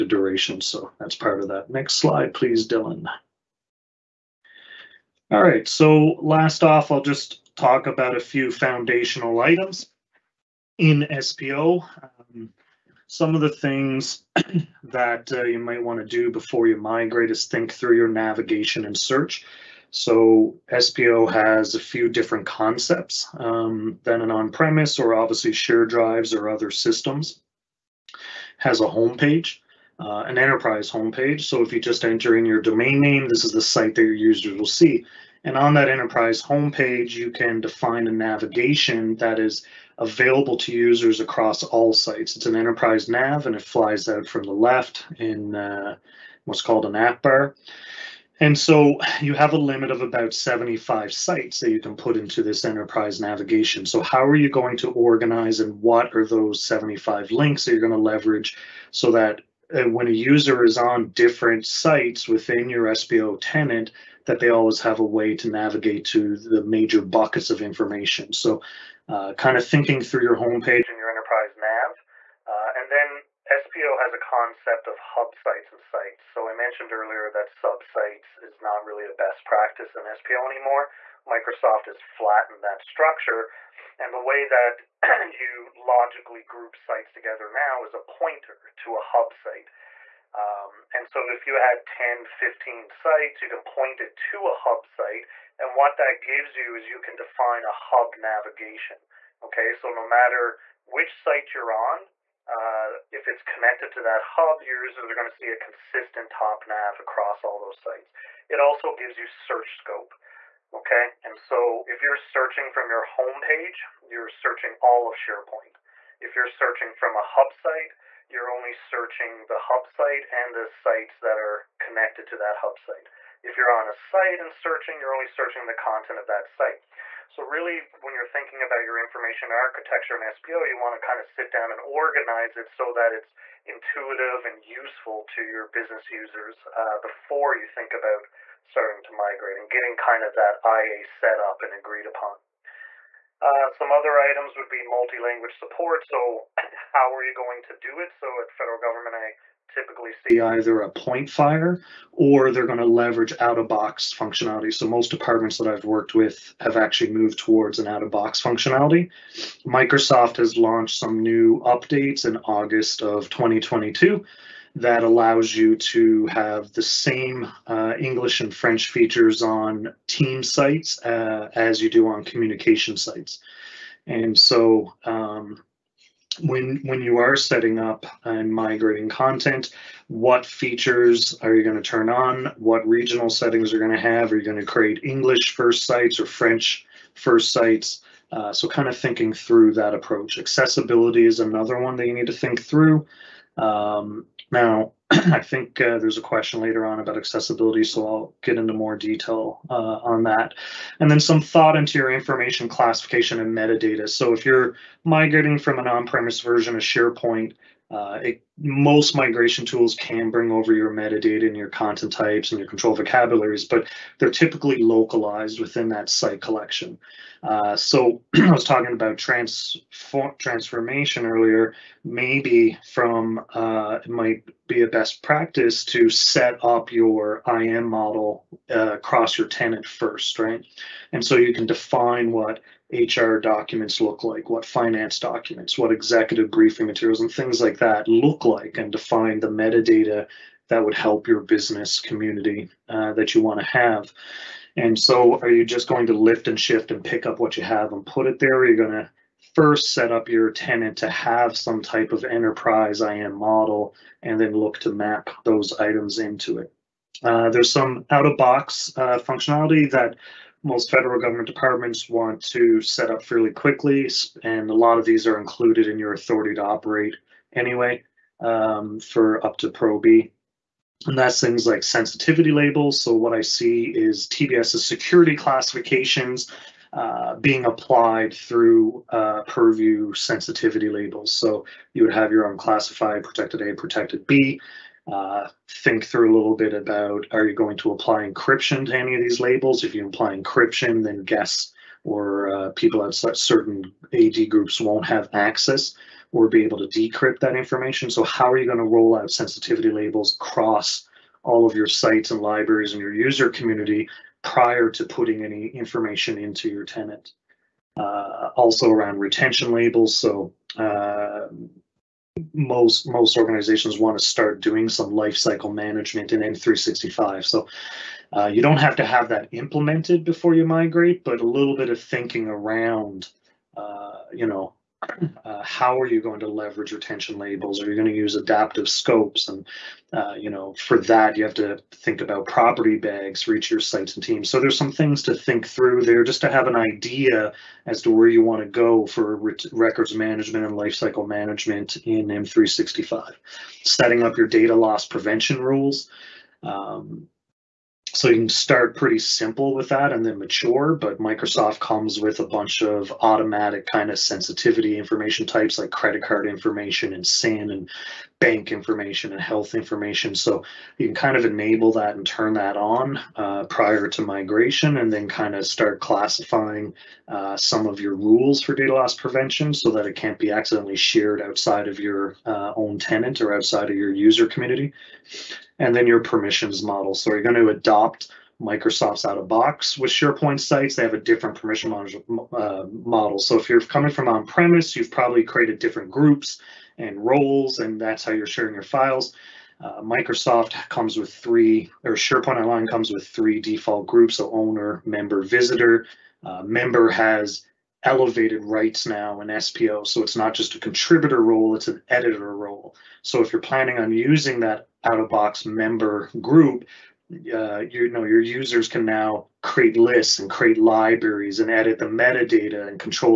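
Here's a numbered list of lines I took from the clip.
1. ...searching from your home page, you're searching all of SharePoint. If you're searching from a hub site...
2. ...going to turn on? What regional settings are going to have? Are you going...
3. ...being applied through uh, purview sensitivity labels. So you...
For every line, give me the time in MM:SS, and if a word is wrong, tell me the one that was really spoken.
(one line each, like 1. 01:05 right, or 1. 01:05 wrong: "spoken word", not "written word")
1. 01:52 right
2. 03:01 right
3. 04:37 right.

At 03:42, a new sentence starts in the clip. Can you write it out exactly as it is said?
Maybe from uh, it might be a best practice to set up your IM model uh, across your tenant first, right?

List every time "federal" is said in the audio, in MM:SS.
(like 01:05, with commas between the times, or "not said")
02:28, 04:20.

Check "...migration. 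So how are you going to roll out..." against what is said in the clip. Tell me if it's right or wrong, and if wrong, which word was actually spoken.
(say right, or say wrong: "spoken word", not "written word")
wrong: "information", not "migration".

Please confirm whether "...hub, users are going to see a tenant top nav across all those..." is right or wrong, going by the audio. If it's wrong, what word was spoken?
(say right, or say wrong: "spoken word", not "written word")
wrong: "consistent", not "tenant".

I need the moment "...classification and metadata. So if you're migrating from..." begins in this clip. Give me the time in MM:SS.
03:22.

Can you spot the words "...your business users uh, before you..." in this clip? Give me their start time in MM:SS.
02:15.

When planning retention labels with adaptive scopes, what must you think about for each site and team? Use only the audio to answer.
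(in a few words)
property bags.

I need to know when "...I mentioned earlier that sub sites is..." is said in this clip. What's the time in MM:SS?
01:16.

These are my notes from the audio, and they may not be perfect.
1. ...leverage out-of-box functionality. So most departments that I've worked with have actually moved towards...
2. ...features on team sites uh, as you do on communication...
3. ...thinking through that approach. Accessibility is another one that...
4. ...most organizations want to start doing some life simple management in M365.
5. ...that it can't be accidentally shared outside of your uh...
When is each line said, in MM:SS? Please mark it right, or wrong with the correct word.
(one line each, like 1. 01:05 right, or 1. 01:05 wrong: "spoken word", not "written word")
1. 02:32 right
2. 02:48 right
3. 03:08 right
4. 05:13 wrong: "cycle", not "simple"
5. 06:09 right.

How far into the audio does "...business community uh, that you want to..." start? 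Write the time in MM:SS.
04:01.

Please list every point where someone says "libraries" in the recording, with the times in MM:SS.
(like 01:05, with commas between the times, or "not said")
05:02, 06:50.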